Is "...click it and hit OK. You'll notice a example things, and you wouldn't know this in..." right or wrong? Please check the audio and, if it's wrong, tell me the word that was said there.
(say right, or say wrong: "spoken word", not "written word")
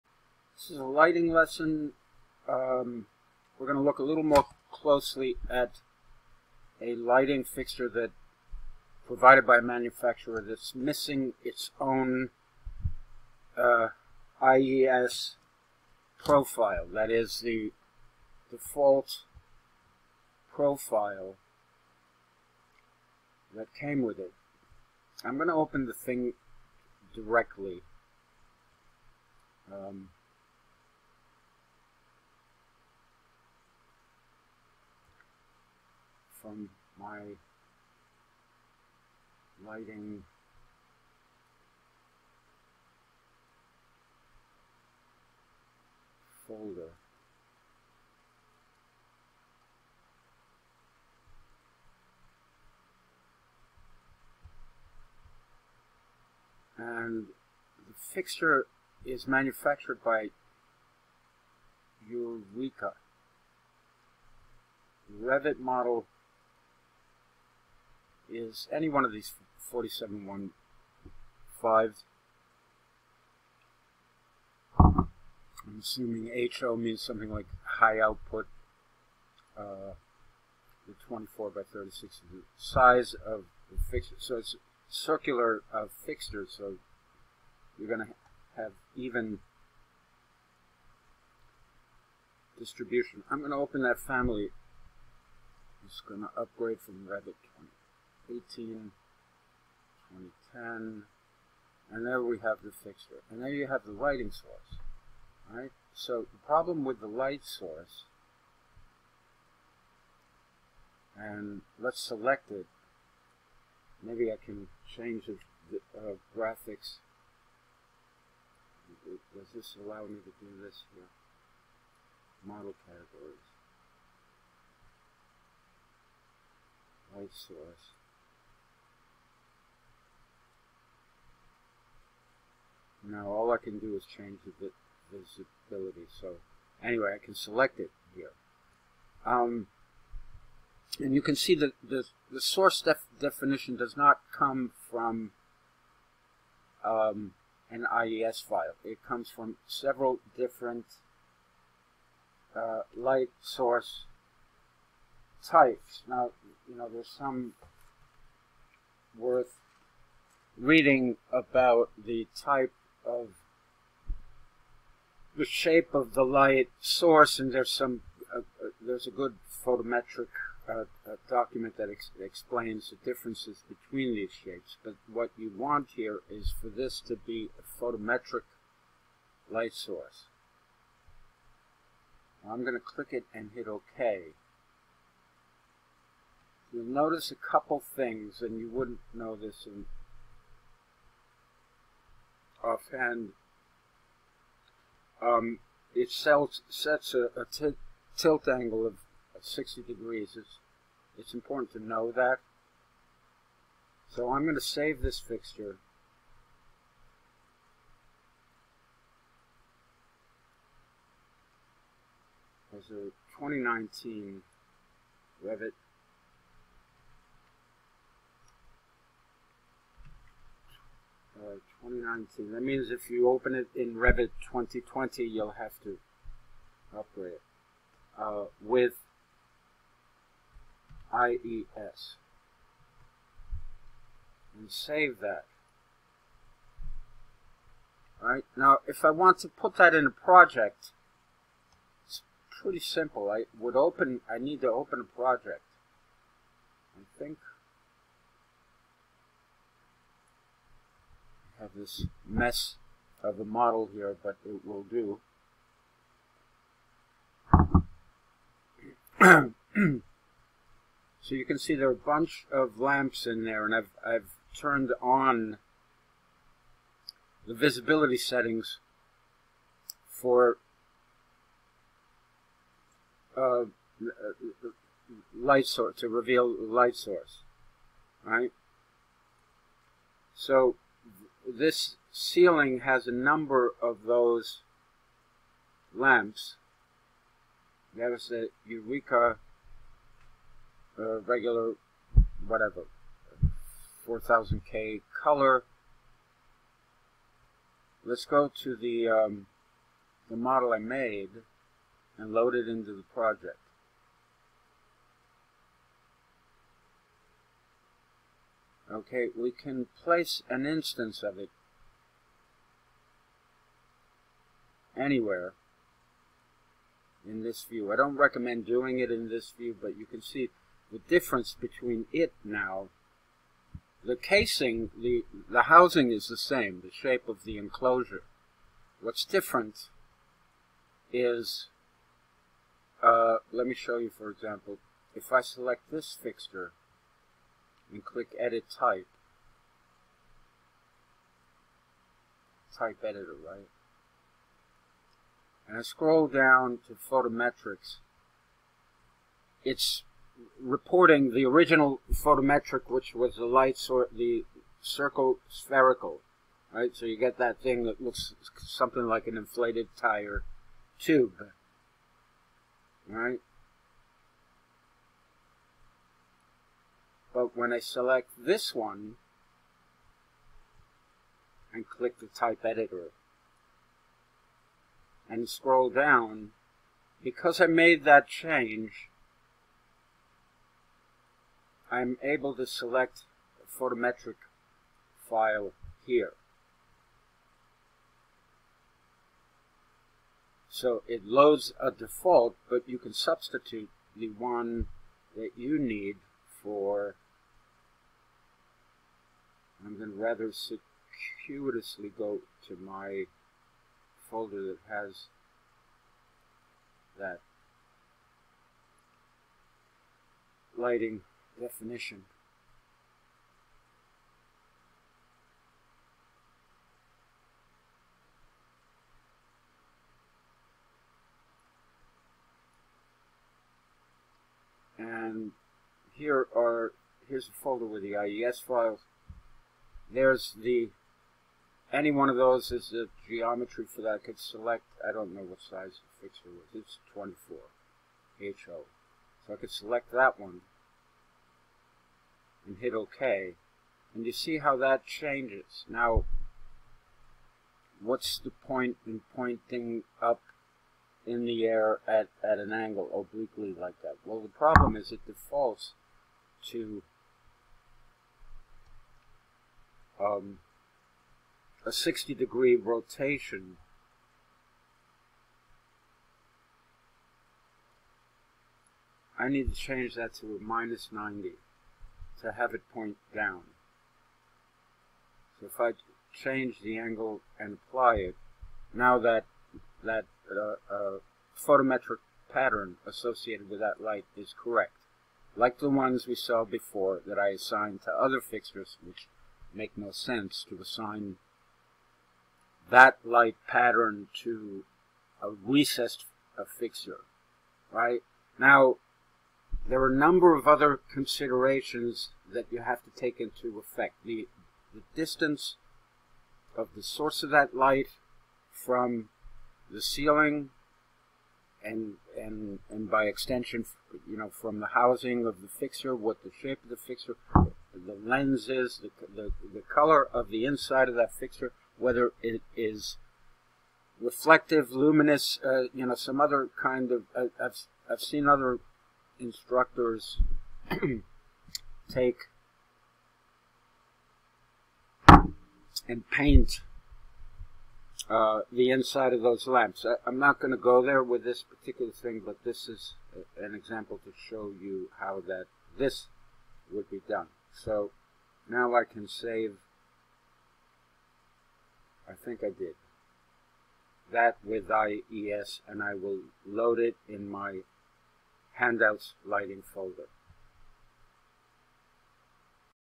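wrong: "couple", not "example".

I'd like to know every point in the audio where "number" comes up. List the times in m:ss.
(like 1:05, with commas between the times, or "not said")
4:43, 8:20.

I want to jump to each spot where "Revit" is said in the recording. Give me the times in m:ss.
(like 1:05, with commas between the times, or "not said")
1:05, 1:37, 3:35, 3:43.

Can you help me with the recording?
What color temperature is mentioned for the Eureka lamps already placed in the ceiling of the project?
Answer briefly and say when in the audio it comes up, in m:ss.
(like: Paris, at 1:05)
4000K, at 4:54.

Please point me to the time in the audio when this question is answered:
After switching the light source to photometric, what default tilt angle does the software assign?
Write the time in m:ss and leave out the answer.
3:19.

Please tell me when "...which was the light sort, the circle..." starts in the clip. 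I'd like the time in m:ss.
5:52.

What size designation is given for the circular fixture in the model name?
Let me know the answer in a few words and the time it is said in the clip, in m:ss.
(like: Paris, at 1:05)
24 by 36, at 1:21.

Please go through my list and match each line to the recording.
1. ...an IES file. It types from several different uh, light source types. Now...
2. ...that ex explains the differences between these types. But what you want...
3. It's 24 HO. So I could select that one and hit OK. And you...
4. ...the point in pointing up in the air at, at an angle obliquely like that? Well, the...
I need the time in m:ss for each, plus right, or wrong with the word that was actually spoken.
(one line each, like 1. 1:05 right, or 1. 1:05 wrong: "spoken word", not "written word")
1. 2:27 wrong: "comes", not "types"
2. 2:51 wrong: "shapes", not "types"
3. 7:16 right
4. 7:28 right.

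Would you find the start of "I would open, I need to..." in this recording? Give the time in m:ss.
4:03.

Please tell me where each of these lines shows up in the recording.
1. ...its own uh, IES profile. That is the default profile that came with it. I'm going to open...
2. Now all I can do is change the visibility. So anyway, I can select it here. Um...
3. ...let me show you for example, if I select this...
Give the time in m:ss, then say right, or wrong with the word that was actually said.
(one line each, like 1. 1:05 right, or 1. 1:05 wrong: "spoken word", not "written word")
1. 0:11 right
2. 2:13 right
3. 5:33 right.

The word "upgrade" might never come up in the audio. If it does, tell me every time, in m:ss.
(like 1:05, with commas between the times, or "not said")
1:36, 3:46.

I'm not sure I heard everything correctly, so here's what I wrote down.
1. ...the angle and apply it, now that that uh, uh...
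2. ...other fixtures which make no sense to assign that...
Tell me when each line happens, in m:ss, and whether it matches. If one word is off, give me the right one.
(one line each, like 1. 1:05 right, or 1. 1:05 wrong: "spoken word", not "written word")
1. 7:56 right
2. 8:08 right.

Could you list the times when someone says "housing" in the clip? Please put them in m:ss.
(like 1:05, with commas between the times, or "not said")
5:25, 8:34.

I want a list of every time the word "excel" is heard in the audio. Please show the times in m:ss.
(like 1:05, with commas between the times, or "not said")
not said.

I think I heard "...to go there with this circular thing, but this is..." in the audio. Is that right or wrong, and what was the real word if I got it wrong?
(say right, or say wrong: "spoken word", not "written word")
wrong: "particular", not "circular".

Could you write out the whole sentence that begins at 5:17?
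I don't recommend doing it in this view, but you can see the difference between it now.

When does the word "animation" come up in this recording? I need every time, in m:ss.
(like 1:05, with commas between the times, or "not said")
not said.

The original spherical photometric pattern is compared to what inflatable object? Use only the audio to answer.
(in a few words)
inflated tire tube.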